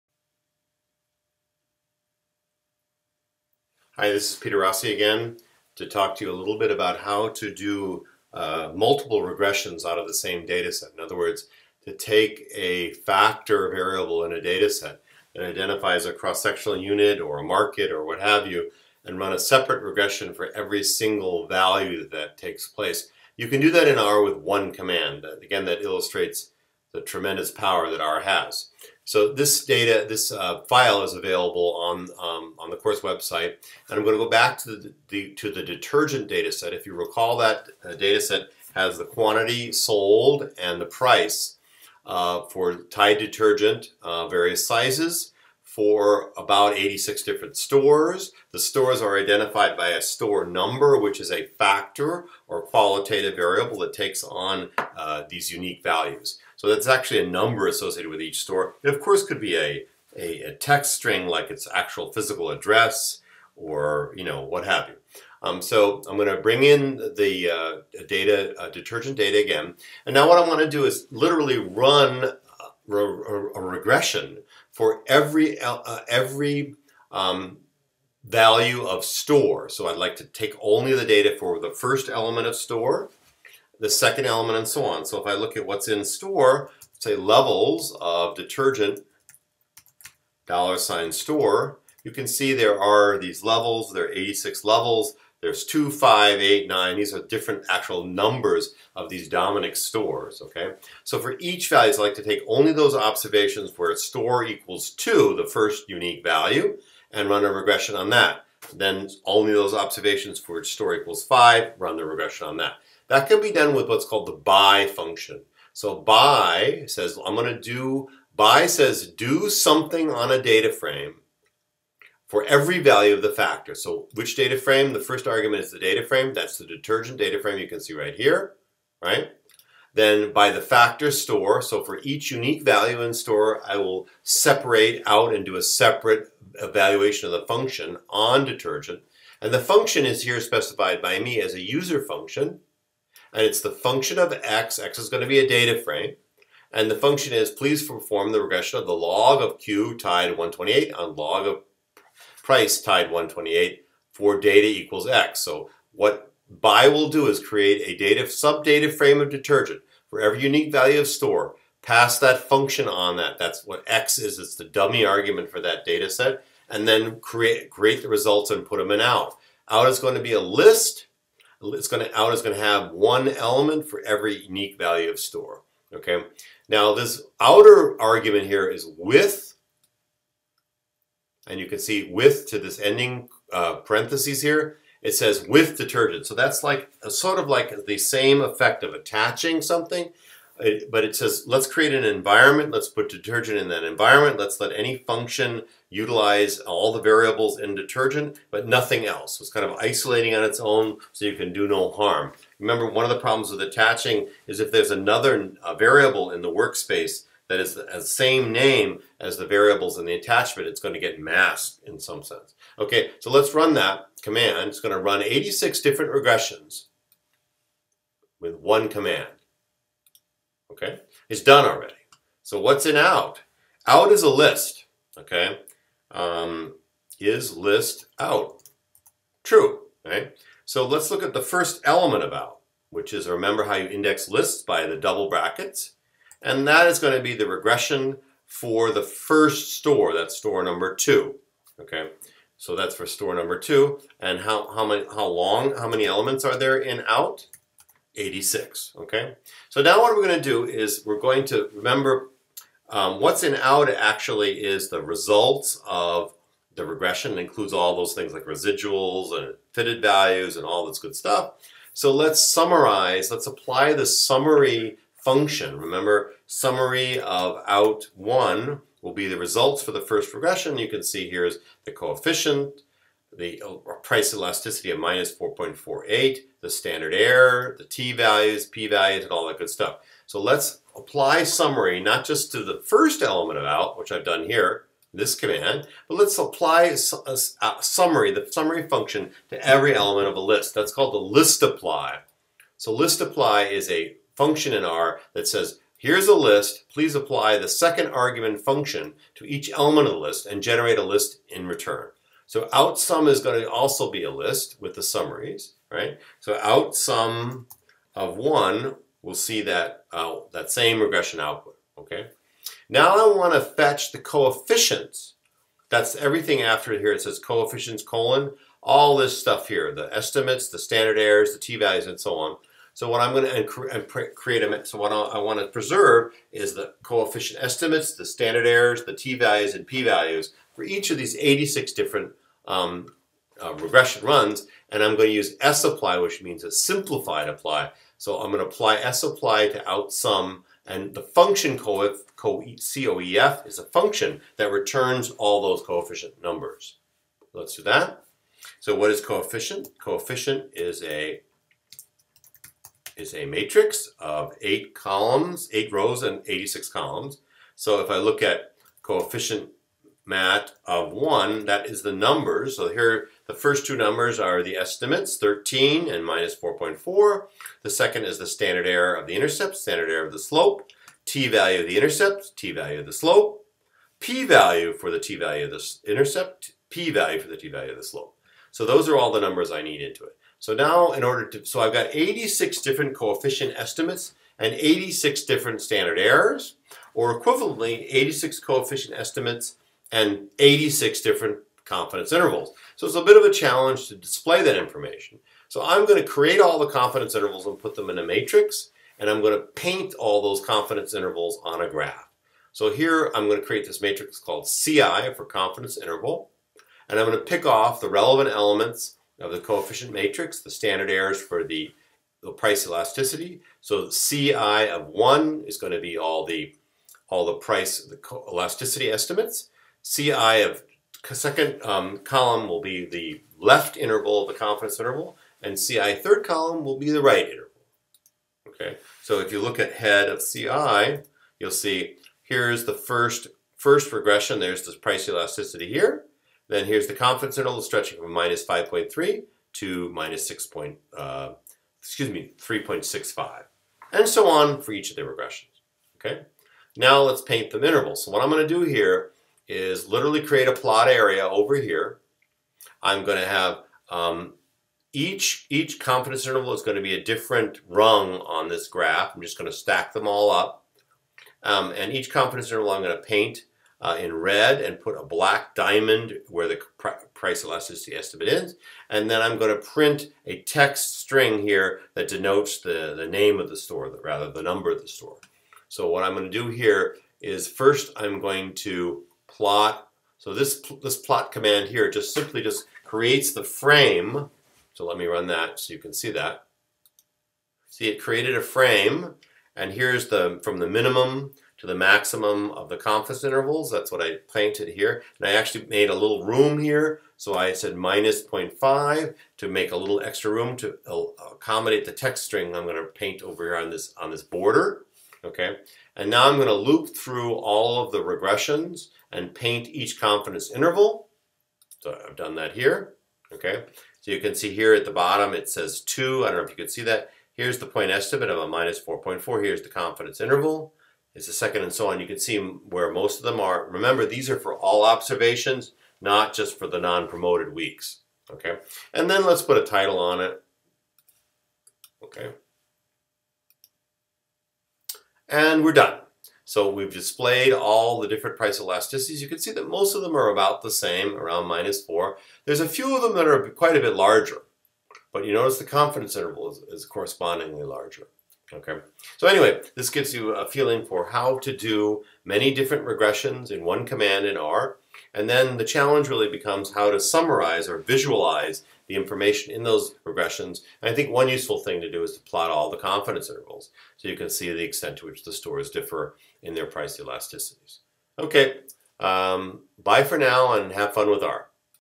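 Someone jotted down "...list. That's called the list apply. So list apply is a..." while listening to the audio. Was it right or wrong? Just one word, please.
right.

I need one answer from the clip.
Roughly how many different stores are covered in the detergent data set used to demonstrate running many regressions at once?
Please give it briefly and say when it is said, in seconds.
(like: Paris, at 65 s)
86, at 46 s.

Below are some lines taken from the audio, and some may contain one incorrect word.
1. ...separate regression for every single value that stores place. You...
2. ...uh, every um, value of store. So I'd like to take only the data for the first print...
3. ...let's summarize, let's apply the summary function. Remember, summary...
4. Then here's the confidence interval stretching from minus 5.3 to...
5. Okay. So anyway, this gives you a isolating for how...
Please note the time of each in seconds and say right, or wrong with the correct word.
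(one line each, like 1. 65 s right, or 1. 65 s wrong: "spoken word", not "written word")
1. 19 s wrong: "takes", not "stores"
2. 75 s wrong: "element", not "print"
3. 262 s right
4. 436 s right
5. 548 s wrong: "feeling", not "isolating".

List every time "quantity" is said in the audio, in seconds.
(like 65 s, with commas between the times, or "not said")
39 s.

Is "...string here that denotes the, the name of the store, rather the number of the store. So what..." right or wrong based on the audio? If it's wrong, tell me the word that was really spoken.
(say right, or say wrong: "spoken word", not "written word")
right.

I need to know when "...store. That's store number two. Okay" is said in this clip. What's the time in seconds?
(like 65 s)
239 s.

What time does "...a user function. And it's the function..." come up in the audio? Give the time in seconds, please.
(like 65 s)
141 s.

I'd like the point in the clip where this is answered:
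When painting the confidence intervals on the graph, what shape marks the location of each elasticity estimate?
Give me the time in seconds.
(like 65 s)
465 s.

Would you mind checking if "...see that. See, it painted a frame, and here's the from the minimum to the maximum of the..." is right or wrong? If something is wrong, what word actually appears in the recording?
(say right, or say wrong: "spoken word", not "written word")
wrong: "created", not "painted".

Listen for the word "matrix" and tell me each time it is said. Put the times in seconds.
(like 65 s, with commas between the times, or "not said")
353 s, 398 s, 404 s, 410 s.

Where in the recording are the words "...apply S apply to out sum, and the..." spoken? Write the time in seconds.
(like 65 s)
338 s.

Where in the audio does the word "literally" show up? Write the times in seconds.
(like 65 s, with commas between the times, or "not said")
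71 s, 450 s.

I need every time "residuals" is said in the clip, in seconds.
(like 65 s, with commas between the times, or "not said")
258 s.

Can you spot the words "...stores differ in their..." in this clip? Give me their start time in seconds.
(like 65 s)
565 s.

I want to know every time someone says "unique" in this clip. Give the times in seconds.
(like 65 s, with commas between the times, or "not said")
55 s, 105 s, 132 s, 160 s, 174 s.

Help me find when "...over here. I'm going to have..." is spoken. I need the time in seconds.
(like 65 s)
451 s.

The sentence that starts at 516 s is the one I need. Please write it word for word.
I don't know if you can see that.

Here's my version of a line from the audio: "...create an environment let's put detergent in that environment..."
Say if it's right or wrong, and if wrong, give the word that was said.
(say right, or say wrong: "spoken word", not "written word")
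right.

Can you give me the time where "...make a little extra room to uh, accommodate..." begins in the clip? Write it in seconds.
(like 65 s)
499 s.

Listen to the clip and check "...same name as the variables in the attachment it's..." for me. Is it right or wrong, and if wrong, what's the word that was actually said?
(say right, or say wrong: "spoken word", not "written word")
right.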